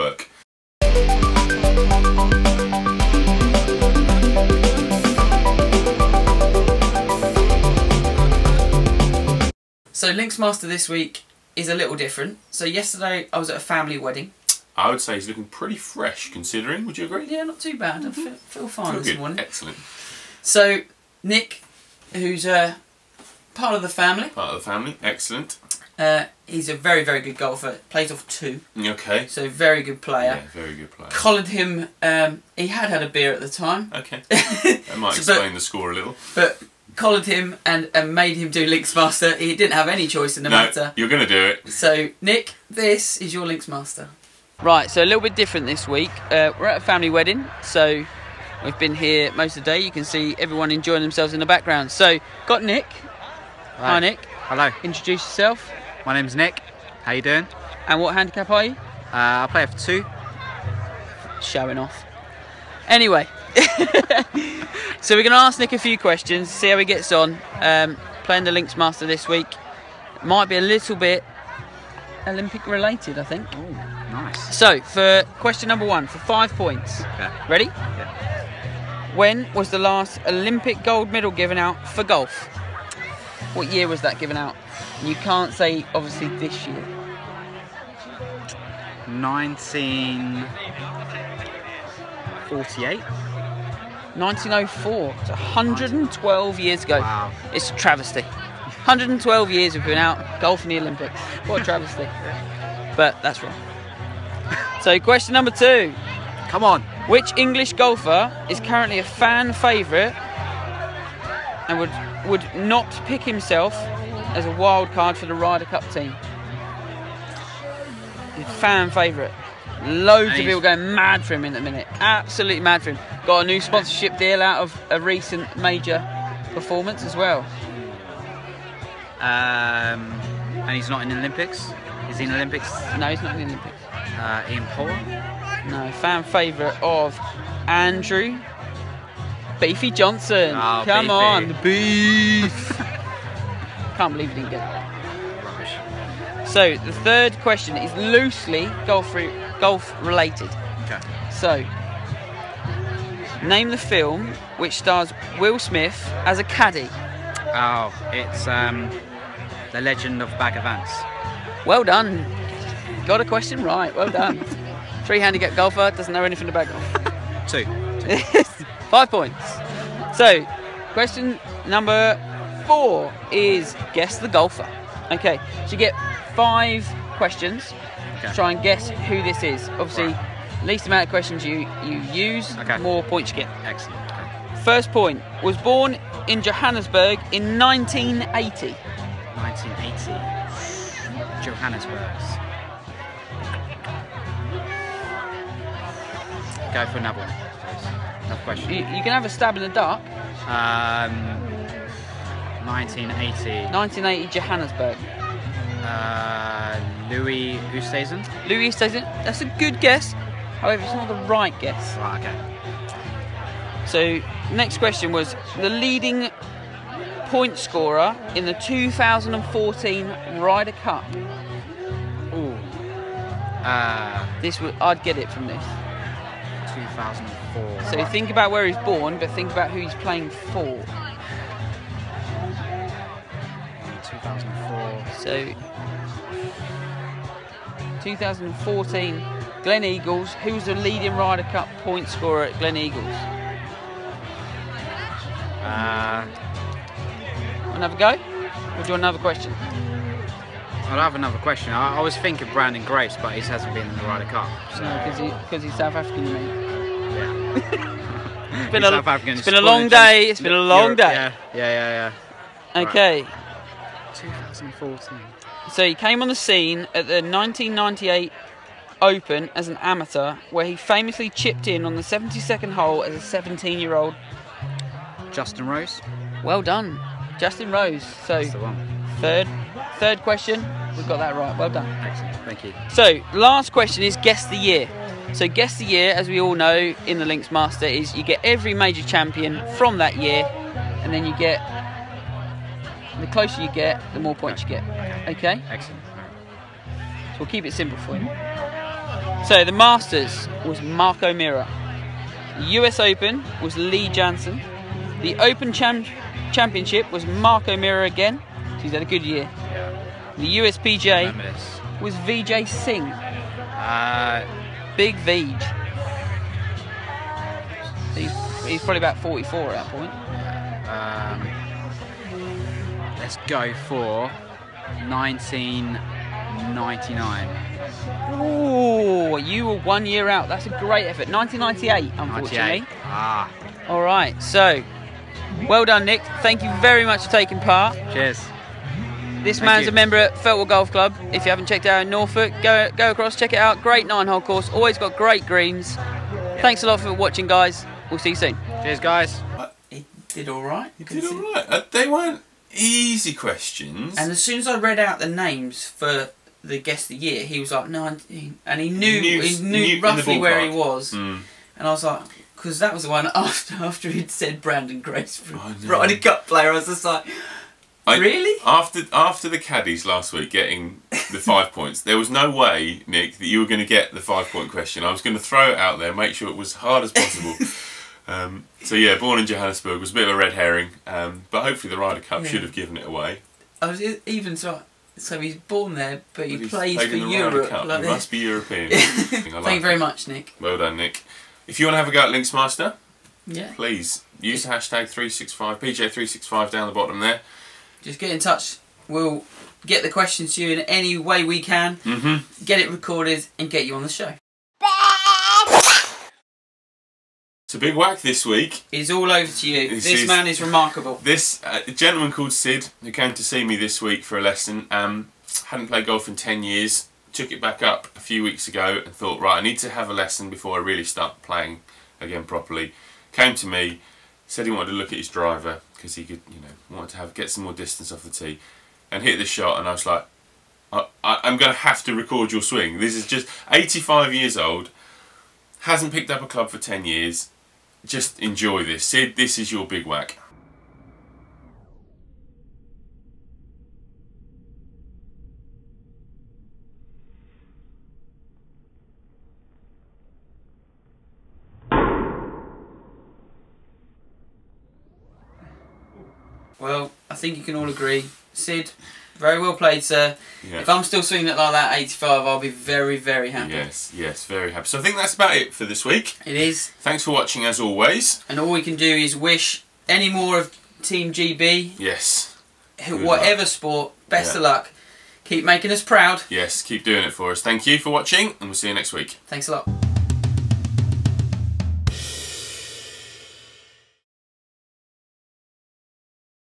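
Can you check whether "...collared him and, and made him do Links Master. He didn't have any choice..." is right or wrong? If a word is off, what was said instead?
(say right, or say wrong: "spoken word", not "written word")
right.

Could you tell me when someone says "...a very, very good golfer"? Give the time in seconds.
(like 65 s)
26 s.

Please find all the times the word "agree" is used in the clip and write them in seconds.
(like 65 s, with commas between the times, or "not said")
17 s, 457 s.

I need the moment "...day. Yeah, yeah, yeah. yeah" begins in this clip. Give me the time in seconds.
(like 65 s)
260 s.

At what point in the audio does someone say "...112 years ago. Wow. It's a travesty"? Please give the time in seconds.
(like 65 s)
95 s.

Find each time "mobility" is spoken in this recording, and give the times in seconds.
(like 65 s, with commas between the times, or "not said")
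not said.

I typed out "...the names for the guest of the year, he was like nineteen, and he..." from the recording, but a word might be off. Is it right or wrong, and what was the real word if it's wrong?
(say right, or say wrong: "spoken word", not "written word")
right.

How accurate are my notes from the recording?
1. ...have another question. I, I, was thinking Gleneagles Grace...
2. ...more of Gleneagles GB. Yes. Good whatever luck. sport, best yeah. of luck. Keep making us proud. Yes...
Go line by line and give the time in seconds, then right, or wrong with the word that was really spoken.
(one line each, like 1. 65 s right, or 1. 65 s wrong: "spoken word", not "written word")
1. 250 s wrong: "Branden", not "Gleneagles"
2. 470 s wrong: "Team", not "Gleneagles".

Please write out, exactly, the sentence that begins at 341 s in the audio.
If you haven't checked out in Norfolk, go go across, check it out.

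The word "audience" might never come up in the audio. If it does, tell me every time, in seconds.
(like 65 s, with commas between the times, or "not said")
not said.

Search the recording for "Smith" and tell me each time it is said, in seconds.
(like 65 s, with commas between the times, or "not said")
155 s.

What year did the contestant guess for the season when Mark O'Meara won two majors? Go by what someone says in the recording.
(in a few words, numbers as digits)
1999.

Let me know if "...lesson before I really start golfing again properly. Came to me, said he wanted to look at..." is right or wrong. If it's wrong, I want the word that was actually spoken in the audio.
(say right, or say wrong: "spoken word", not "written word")
wrong: "playing", not "golfing".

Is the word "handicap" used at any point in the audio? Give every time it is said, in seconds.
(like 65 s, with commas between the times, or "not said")
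58 s, 165 s.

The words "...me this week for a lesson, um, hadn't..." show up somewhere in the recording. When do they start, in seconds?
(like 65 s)
413 s.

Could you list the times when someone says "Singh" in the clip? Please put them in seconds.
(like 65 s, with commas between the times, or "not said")
312 s.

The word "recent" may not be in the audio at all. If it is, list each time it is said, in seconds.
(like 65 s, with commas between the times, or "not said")
124 s.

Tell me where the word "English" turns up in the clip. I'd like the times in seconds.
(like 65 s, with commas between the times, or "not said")
107 s.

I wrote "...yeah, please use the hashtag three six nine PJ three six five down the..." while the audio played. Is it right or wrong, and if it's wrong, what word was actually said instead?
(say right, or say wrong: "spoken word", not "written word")
wrong: "five", not "nine".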